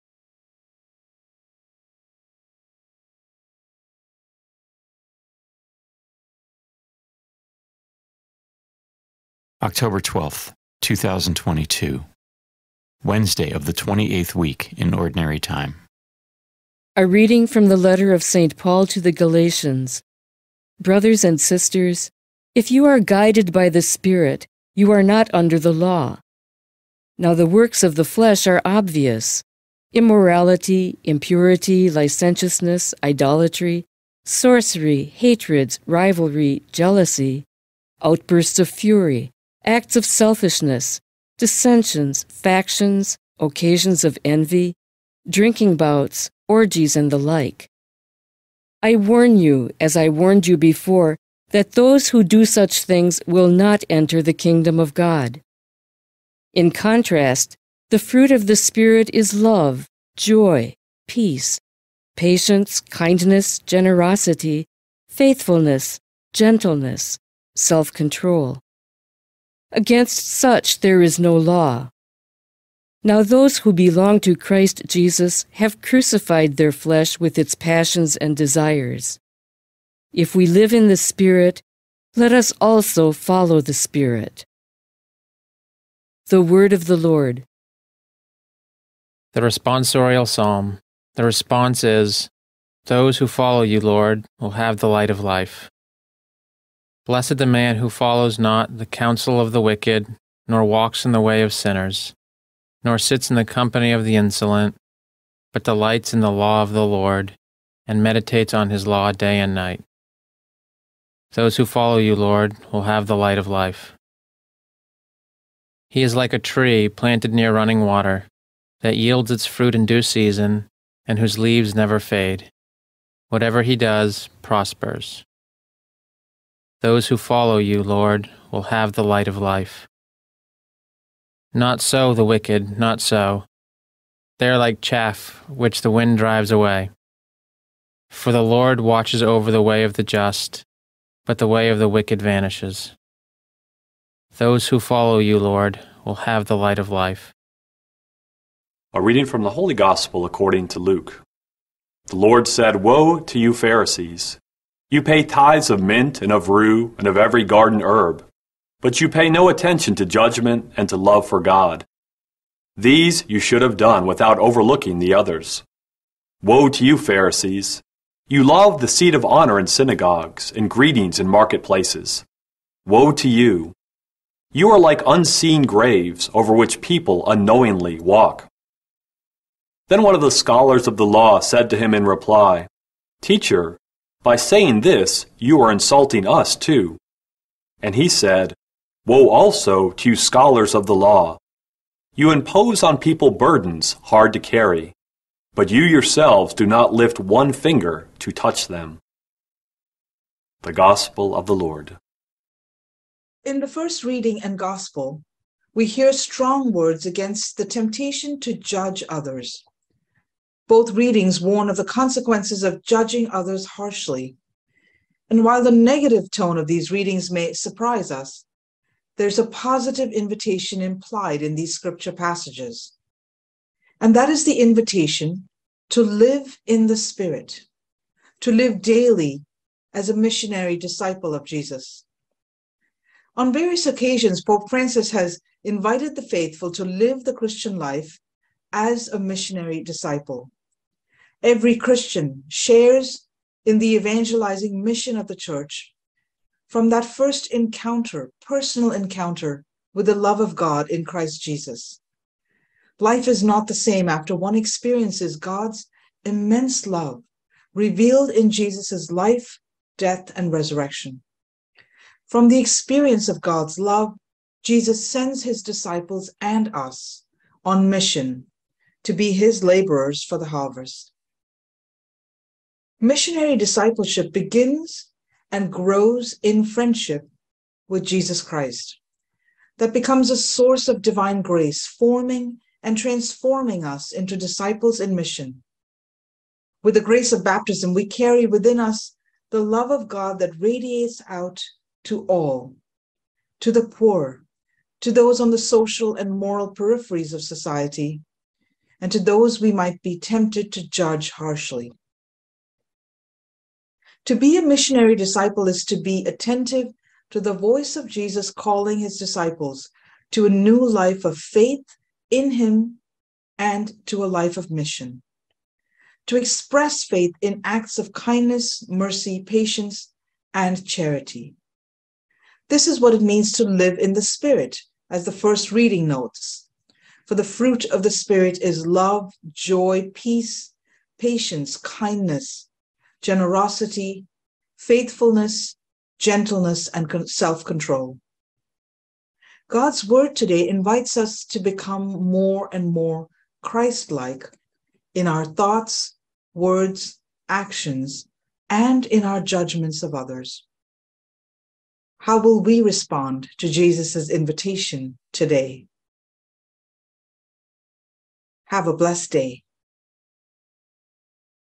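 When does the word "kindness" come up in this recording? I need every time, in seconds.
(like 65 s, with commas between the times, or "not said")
62 s, 318 s, 331 s.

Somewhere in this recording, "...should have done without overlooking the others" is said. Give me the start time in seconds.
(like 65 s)
163 s.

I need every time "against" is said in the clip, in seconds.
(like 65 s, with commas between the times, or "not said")
69 s, 207 s.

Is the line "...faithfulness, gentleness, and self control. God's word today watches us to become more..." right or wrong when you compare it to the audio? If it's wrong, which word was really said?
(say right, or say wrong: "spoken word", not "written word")
wrong: "invites", not "watches".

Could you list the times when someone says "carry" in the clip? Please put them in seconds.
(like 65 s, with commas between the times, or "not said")
194 s, 288 s.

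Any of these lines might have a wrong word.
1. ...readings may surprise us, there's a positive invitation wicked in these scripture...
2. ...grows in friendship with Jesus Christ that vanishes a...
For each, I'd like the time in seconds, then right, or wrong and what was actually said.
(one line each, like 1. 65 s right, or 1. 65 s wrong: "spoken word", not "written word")
1. 216 s wrong: "implied", not "wicked"
2. 275 s wrong: "becomes", not "vanishes".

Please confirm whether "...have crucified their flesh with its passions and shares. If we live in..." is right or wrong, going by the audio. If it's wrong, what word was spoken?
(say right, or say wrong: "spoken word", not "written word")
wrong: "desires", not "shares".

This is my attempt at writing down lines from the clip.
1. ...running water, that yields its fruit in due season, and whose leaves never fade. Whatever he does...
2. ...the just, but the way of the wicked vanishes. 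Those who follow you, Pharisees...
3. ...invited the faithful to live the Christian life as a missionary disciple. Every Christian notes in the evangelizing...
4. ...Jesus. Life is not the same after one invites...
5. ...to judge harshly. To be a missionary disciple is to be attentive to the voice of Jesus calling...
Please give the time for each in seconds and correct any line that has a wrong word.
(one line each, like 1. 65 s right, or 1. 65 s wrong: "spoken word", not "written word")
1. 117 s right
2. 139 s wrong: "Lord", not "Pharisees"
3. 235 s wrong: "shares", not "notes"
4. 251 s wrong: "experiences", not "invites"
5. 300 s right.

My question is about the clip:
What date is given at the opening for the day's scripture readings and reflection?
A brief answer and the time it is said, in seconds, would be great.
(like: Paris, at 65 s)
October 12th, 2022, at 9 s.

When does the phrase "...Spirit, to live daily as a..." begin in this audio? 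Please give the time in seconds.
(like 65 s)
226 s.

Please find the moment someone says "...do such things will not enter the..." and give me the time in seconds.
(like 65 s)
52 s.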